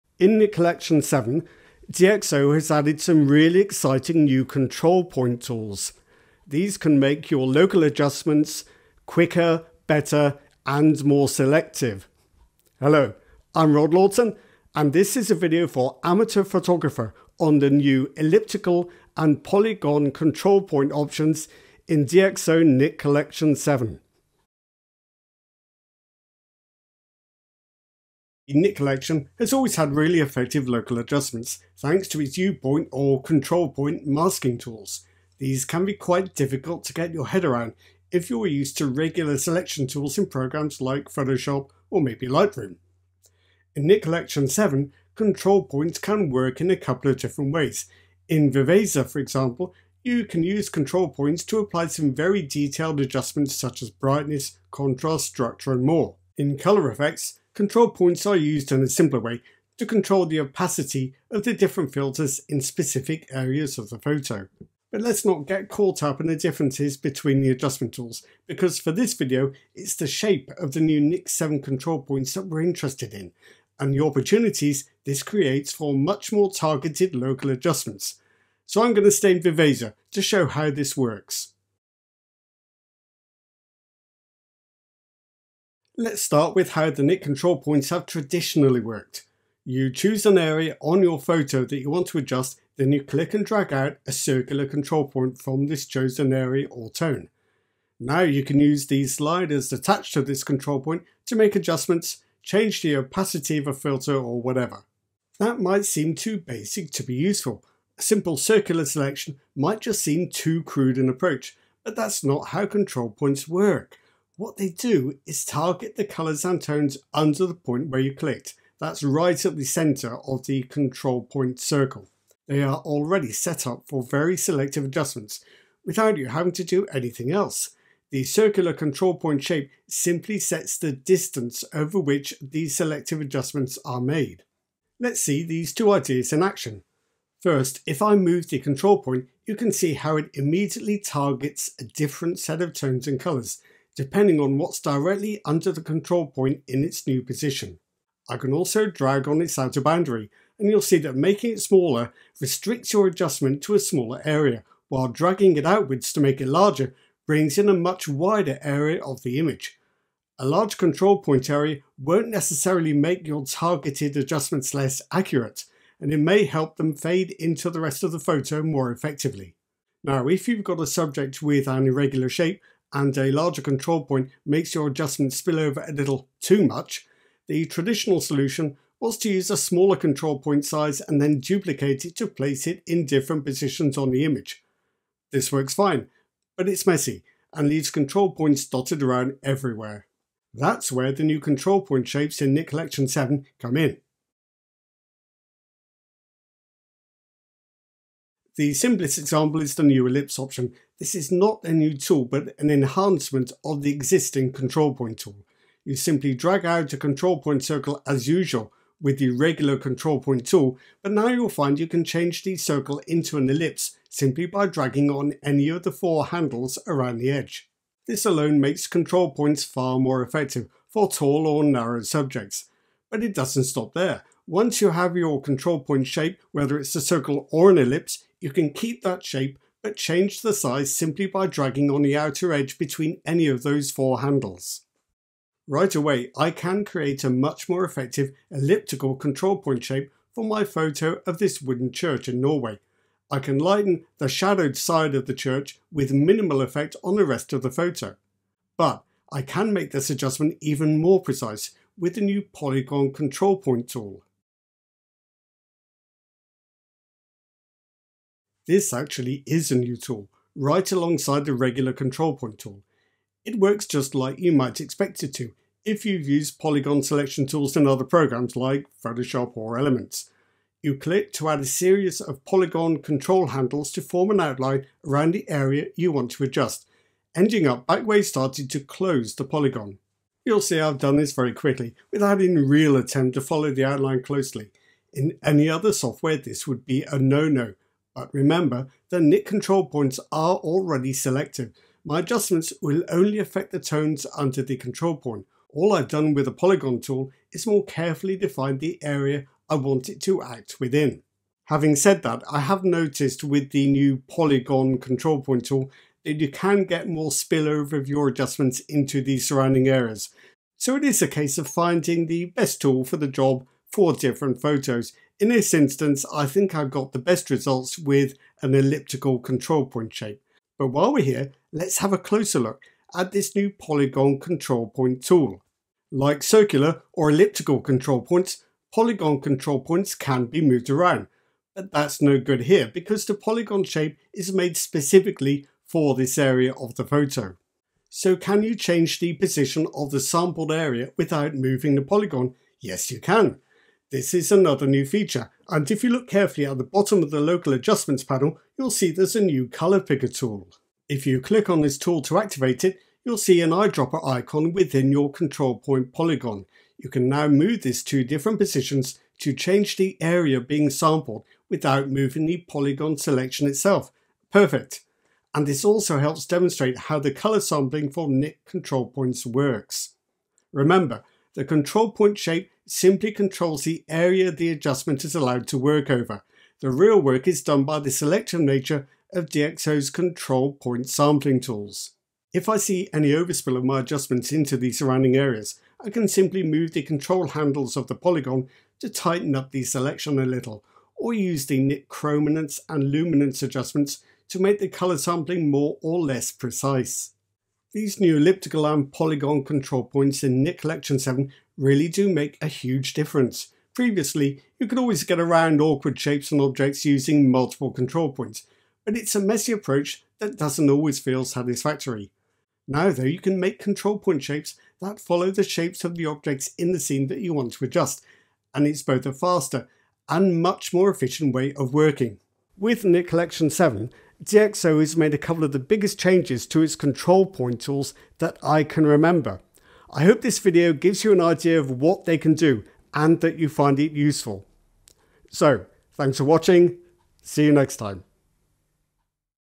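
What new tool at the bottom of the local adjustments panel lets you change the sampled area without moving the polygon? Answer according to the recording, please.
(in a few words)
color picker.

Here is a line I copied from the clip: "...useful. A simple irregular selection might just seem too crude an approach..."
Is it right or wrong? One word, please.
wrong.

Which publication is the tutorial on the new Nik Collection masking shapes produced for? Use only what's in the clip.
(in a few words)
Amateur Photographer.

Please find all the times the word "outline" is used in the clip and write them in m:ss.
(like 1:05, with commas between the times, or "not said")
4:34, 4:43.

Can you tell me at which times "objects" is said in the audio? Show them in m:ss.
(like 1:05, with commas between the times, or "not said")
6:46, 6:56.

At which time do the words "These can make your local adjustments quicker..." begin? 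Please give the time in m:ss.
0:06.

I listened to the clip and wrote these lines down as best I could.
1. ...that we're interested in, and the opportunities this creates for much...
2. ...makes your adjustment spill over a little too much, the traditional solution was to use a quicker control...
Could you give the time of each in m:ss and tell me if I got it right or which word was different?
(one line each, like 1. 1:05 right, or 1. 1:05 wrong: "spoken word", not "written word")
1. 1:12 right
2. 2:54 wrong: "smaller", not "quicker".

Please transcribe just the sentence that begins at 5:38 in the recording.
So can you change the position of the sampled area without moving the polygon?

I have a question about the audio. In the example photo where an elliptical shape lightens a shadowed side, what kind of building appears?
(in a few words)
wooden church.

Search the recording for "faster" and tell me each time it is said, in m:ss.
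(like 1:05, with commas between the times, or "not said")
6:59.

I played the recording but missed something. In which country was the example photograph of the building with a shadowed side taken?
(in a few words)
Norway.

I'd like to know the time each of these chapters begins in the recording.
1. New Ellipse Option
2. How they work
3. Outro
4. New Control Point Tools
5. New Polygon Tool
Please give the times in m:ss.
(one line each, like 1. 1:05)
1. 3:14
2. 1:25
3. 7:03
4. 0:25
5. 4:14.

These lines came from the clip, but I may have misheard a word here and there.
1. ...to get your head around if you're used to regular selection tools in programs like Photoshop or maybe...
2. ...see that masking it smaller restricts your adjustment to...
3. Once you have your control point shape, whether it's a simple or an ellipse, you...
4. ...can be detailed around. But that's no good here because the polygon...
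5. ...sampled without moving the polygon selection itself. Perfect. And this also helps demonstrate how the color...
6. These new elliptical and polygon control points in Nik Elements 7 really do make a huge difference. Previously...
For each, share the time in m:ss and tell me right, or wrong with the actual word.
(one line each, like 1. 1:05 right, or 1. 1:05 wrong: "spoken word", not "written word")
1. 0:36 right
2. 2:30 wrong: "making", not "masking"
3. 3:44 wrong: "circle", not "simple"
4. 5:30 wrong: "moved", not "detailed"
5. 6:00 right
6. 6:37 wrong: "Collection", not "Elements".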